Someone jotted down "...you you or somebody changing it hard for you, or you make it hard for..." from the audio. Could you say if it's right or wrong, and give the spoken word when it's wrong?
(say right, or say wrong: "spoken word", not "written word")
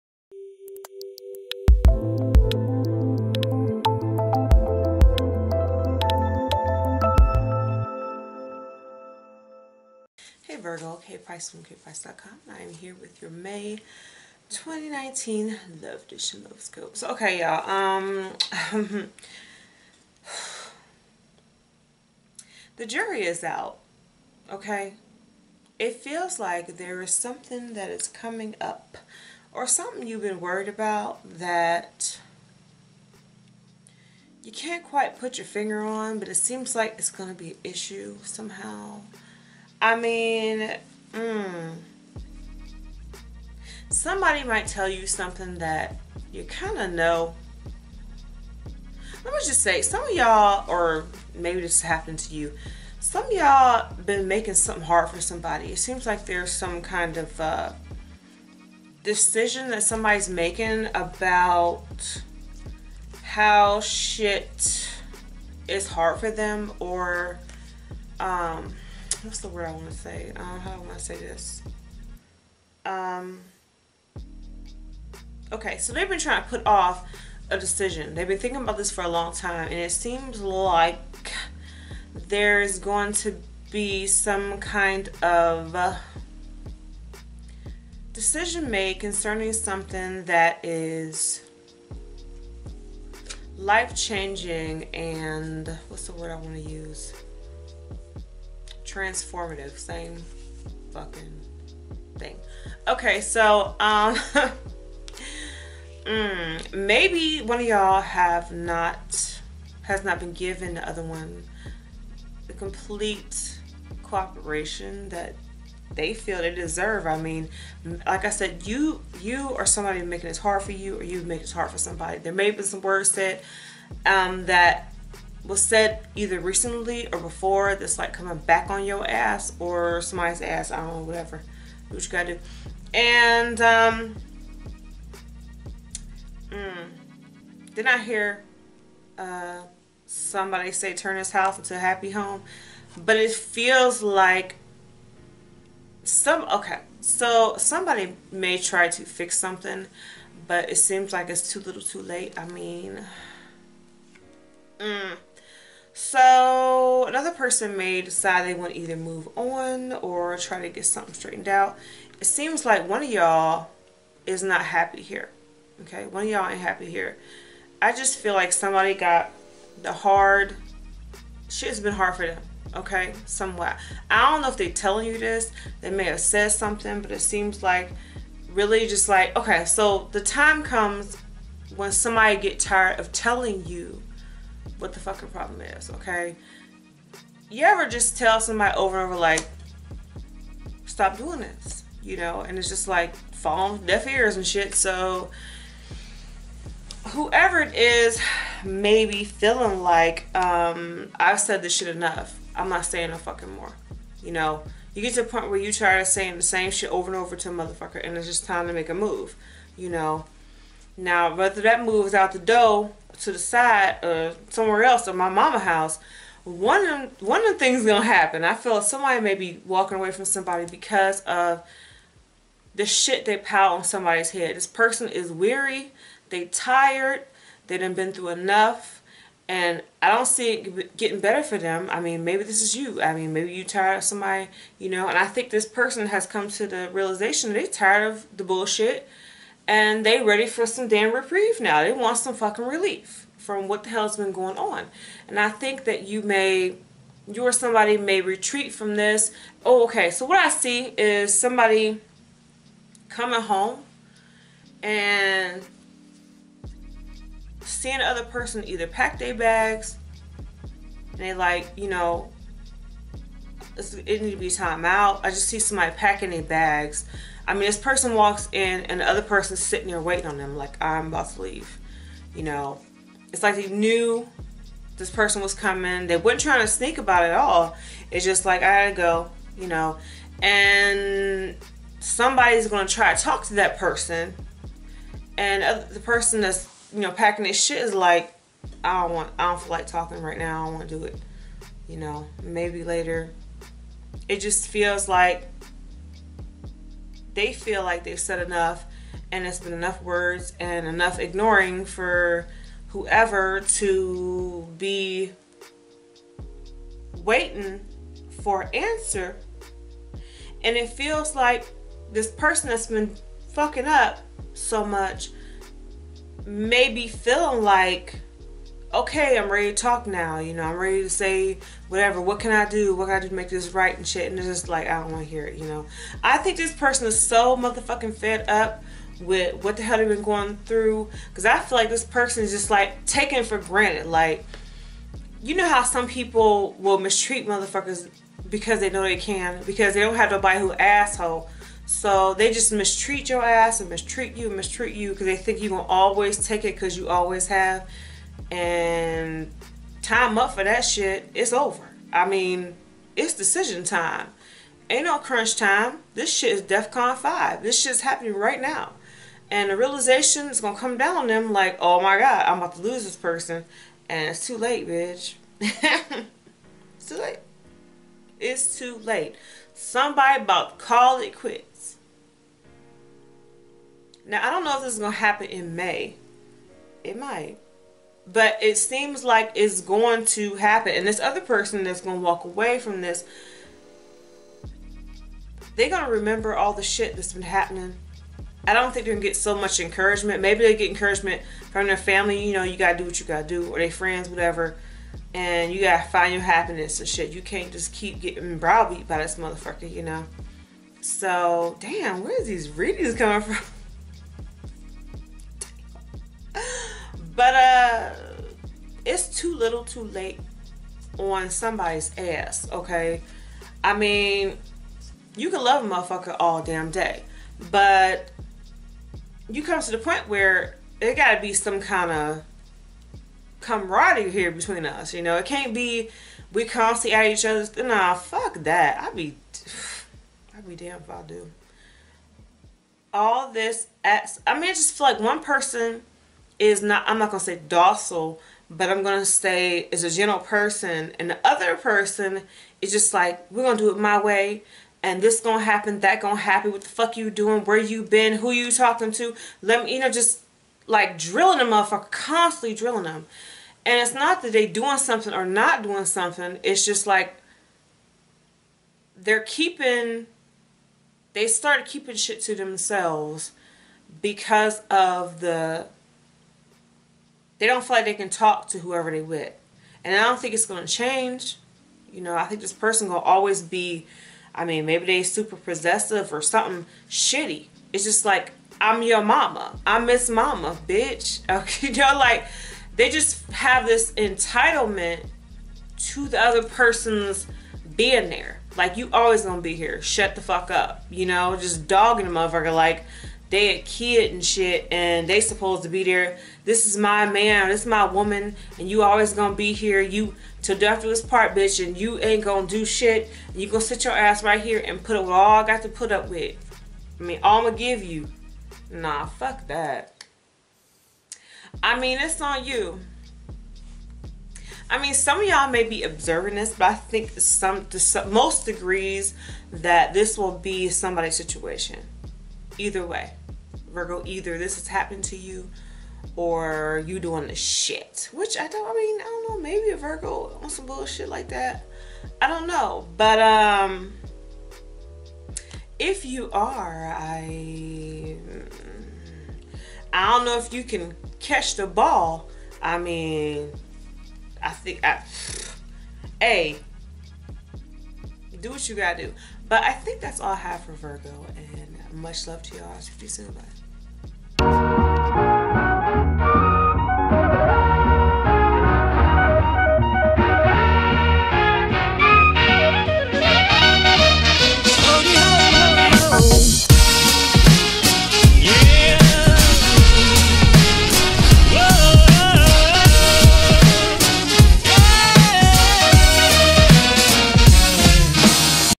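wrong: "making", not "changing".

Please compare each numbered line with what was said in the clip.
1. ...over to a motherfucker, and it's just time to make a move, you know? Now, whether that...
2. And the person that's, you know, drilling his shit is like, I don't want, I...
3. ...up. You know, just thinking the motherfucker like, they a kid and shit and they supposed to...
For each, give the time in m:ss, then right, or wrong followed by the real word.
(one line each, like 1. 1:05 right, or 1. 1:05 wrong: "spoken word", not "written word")
1. 3:27 right
2. 4:45 wrong: "packing", not "drilling"
3. 8:10 wrong: "dogging", not "thinking".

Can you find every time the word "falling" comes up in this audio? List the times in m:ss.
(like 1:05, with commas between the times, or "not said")
3:13.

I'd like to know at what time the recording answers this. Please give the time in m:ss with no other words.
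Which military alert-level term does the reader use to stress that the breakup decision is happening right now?
5:56.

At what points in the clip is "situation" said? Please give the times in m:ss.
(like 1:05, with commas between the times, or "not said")
8:41.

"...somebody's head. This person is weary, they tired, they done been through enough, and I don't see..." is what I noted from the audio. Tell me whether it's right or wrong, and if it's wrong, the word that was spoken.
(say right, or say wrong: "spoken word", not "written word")
right.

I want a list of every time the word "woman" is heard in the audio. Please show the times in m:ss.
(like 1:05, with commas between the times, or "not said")
8:18.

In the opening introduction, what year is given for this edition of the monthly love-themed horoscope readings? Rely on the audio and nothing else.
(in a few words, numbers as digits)
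2019.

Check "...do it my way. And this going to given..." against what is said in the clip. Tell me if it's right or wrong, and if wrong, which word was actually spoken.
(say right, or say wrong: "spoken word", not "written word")
wrong: "happen", not "given".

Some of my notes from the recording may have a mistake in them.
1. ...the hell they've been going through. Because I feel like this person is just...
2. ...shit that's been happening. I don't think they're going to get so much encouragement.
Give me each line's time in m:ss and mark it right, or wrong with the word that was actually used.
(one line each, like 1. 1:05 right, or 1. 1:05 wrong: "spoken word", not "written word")
1. 5:29 right
2. 6:26 right.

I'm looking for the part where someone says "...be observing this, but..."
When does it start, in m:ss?
8:35.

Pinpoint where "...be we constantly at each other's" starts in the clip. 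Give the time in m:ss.
7:05.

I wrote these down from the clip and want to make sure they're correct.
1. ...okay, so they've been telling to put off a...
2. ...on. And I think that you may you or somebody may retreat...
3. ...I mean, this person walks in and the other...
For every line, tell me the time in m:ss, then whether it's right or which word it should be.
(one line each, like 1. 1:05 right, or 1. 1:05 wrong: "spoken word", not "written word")
1. 1:15 wrong: "trying", not "telling"
2. 4:04 right
3. 4:27 right.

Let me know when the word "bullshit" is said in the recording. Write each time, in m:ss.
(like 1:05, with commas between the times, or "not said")
3:58, 8:50.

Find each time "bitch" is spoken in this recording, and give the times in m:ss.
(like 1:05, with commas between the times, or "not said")
6:04, 8:00, 8:21.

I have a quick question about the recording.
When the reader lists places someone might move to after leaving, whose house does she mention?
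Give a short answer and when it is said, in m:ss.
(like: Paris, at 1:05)
My mama's house, at 3:35.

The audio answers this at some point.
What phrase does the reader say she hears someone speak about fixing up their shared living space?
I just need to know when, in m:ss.
2:20.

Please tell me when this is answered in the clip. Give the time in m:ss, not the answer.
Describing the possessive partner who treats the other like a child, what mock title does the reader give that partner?
8:00.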